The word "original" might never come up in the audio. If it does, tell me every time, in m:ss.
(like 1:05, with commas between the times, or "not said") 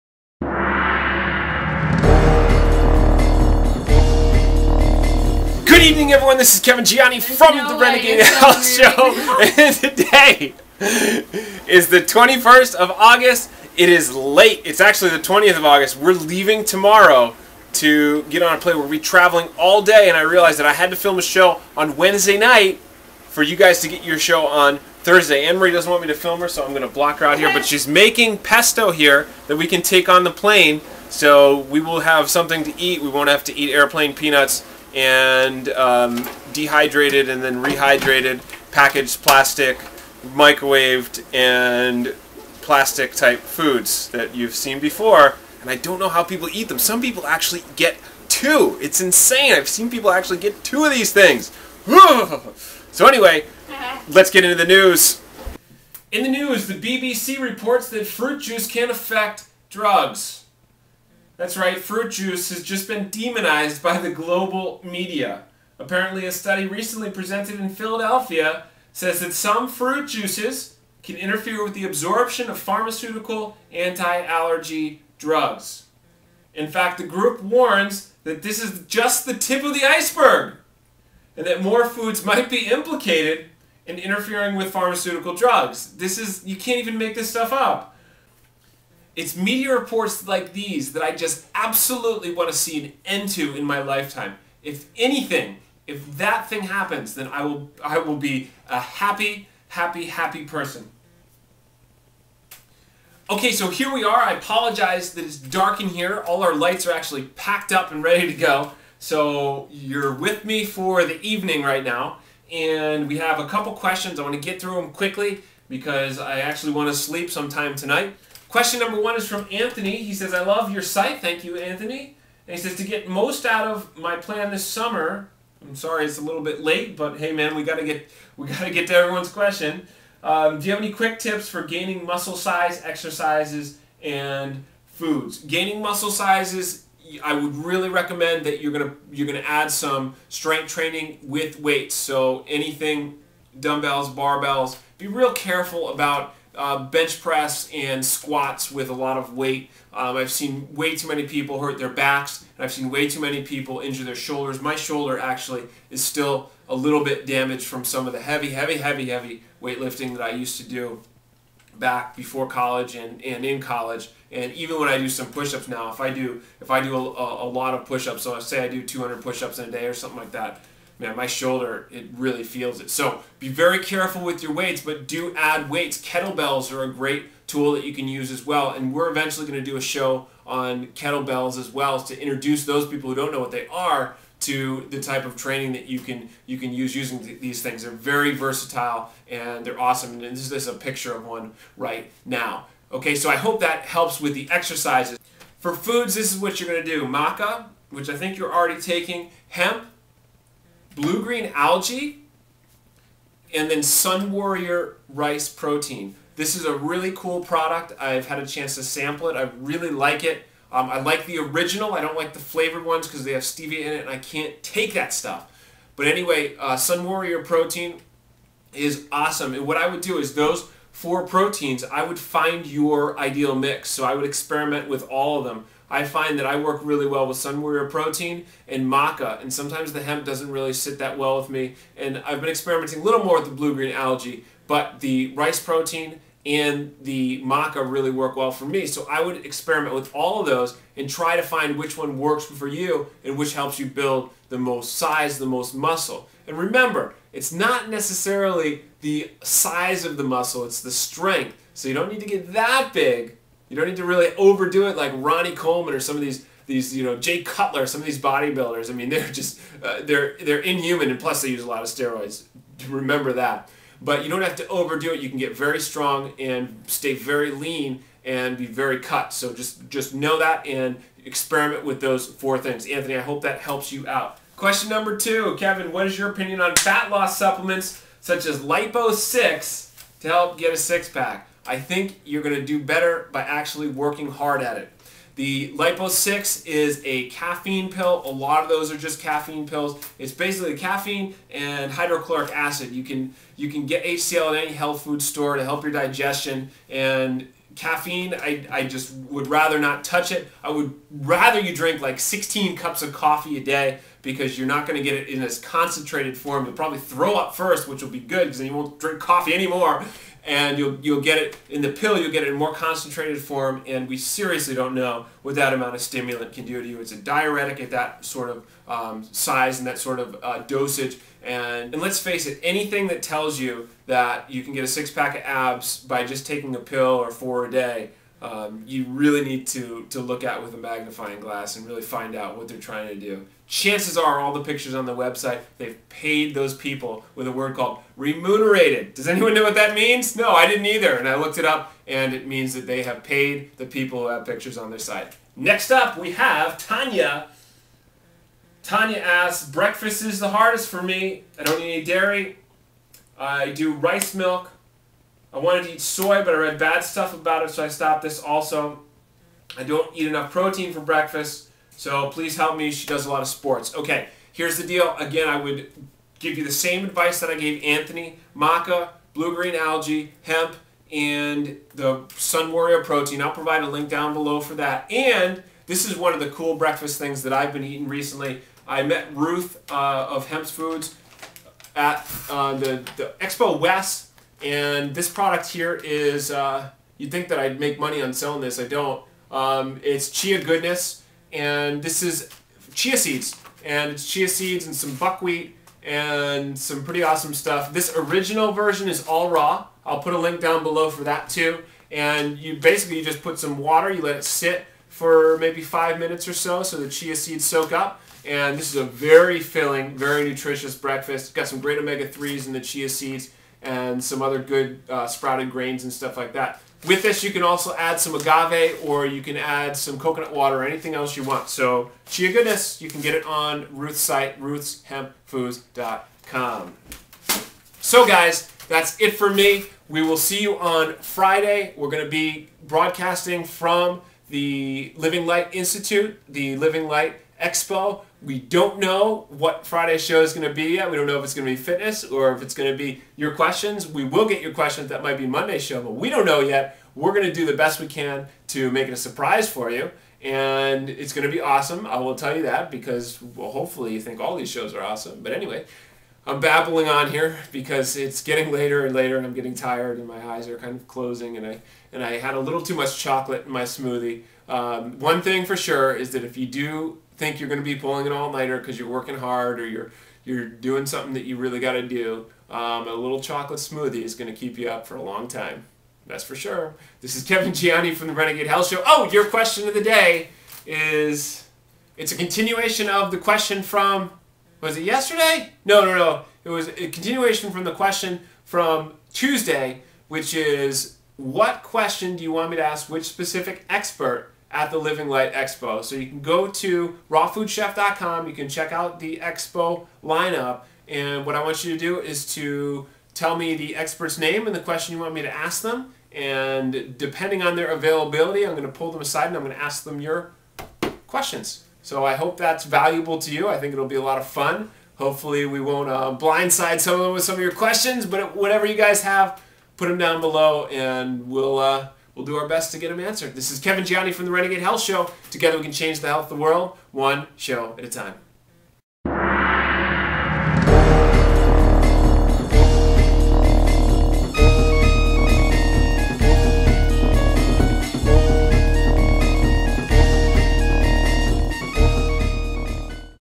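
3:31, 6:38.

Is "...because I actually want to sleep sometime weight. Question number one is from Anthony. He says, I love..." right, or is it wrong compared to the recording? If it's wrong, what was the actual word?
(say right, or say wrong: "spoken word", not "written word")
wrong: "tonight", not "weight".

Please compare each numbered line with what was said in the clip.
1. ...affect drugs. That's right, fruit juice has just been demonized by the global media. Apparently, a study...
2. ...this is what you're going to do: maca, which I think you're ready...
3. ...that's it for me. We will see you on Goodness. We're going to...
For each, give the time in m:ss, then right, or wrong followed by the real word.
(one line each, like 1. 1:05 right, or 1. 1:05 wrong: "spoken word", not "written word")
1. 0:58 right
2. 3:16 wrong: "already", not "ready"
3. 7:08 wrong: "Friday", not "Goodness".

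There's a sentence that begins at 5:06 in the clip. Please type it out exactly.
You'll probably throw up first, which will be good because then you won't drink coffee anymore.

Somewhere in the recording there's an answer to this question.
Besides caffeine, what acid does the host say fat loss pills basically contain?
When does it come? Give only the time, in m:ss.
4:51.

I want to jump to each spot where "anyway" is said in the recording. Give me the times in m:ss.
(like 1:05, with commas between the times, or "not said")
0:53, 3:36, 7:35.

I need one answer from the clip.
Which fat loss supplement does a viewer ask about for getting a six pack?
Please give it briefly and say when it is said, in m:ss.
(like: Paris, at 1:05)
Lipo 6, at 4:38.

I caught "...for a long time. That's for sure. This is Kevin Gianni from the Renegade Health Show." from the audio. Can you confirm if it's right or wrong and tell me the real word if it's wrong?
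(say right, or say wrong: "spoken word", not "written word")
right.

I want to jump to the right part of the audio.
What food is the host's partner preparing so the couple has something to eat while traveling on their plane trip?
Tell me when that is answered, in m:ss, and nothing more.
0:28.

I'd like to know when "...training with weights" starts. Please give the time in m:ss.
2:20.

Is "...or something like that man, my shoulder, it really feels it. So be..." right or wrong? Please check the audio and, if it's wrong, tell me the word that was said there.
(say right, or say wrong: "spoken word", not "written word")
right.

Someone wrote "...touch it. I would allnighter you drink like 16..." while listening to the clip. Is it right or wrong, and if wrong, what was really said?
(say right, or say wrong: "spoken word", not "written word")
wrong: "rather", not "allnighter".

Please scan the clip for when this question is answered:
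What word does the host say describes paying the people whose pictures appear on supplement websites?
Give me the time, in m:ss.
5:38.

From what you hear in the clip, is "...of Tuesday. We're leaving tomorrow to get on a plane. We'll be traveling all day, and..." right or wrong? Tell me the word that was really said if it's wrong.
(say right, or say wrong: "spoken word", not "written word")
wrong: "August", not "Tuesday".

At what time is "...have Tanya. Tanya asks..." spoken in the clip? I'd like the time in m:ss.
5:46.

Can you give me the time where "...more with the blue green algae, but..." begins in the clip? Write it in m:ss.
3:53.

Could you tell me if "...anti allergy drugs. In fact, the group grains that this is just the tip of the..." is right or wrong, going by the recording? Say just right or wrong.
wrong.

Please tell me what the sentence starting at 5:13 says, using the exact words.
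And we seriously don't know what that amount of stimulant can do to you.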